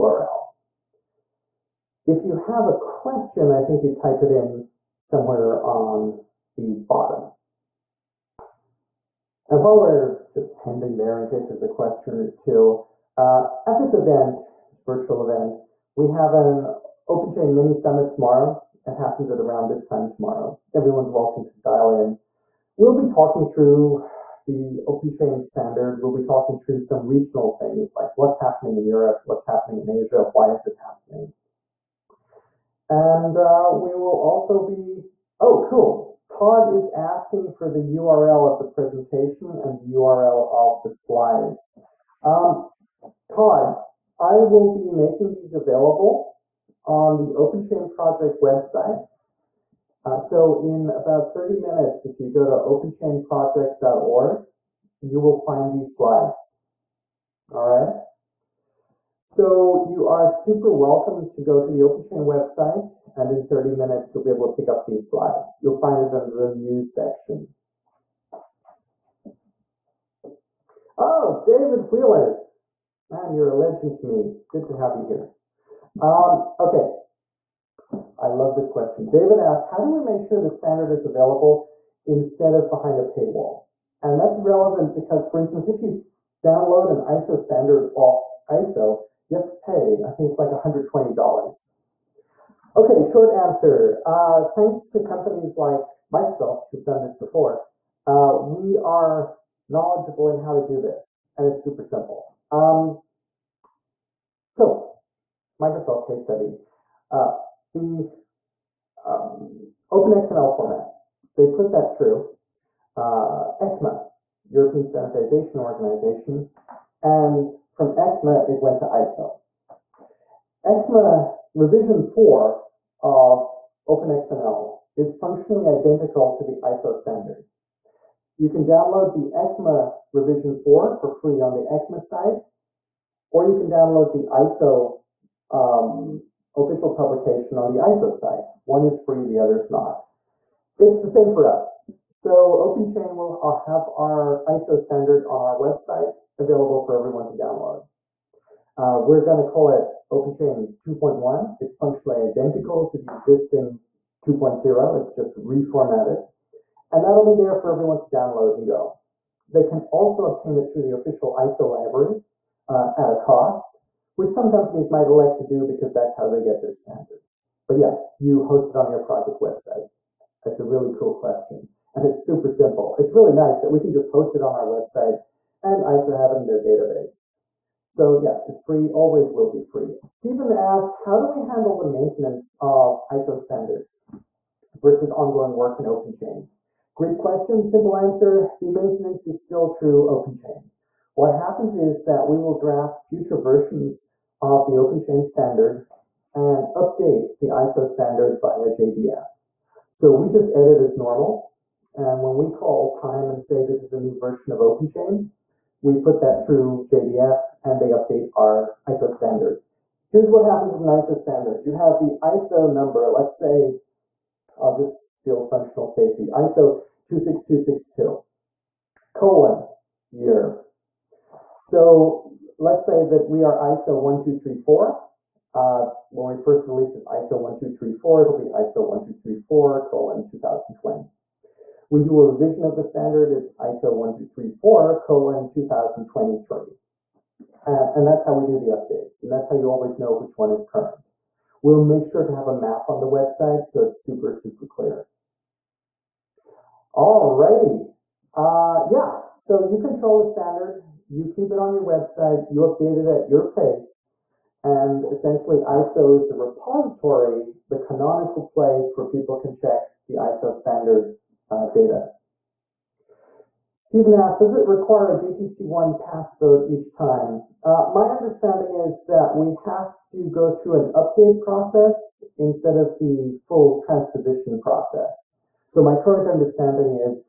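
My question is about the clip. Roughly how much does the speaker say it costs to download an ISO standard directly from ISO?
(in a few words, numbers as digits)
$120.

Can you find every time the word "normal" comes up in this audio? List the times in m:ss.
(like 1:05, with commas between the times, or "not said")
3:20.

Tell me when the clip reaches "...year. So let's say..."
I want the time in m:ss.
3:40.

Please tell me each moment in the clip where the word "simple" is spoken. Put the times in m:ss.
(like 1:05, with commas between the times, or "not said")
1:41, 2:52, 3:07.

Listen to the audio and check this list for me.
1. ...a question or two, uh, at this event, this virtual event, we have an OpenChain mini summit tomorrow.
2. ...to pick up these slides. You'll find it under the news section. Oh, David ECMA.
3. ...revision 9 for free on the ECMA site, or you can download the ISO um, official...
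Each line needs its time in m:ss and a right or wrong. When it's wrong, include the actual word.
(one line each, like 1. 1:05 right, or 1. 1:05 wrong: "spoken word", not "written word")
1. 0:11 right
2. 1:04 wrong: "Wheeler", not "ECMA"
3. 2:10 wrong: "4", not "9".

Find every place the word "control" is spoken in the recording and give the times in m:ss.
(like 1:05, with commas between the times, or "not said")
4:09.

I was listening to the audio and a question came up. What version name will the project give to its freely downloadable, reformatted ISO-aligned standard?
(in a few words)
OpenChain 2.1.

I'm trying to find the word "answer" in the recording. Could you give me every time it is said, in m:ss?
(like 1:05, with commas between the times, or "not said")
1:33, 3:07.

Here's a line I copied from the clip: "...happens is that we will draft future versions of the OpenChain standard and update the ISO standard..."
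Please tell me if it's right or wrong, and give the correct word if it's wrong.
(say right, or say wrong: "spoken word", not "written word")
right.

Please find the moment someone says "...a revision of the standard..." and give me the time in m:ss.
3:52.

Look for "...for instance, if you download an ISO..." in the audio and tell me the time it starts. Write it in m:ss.
1:25.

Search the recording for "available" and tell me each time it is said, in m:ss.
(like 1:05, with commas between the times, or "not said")
0:45, 1:21, 2:26.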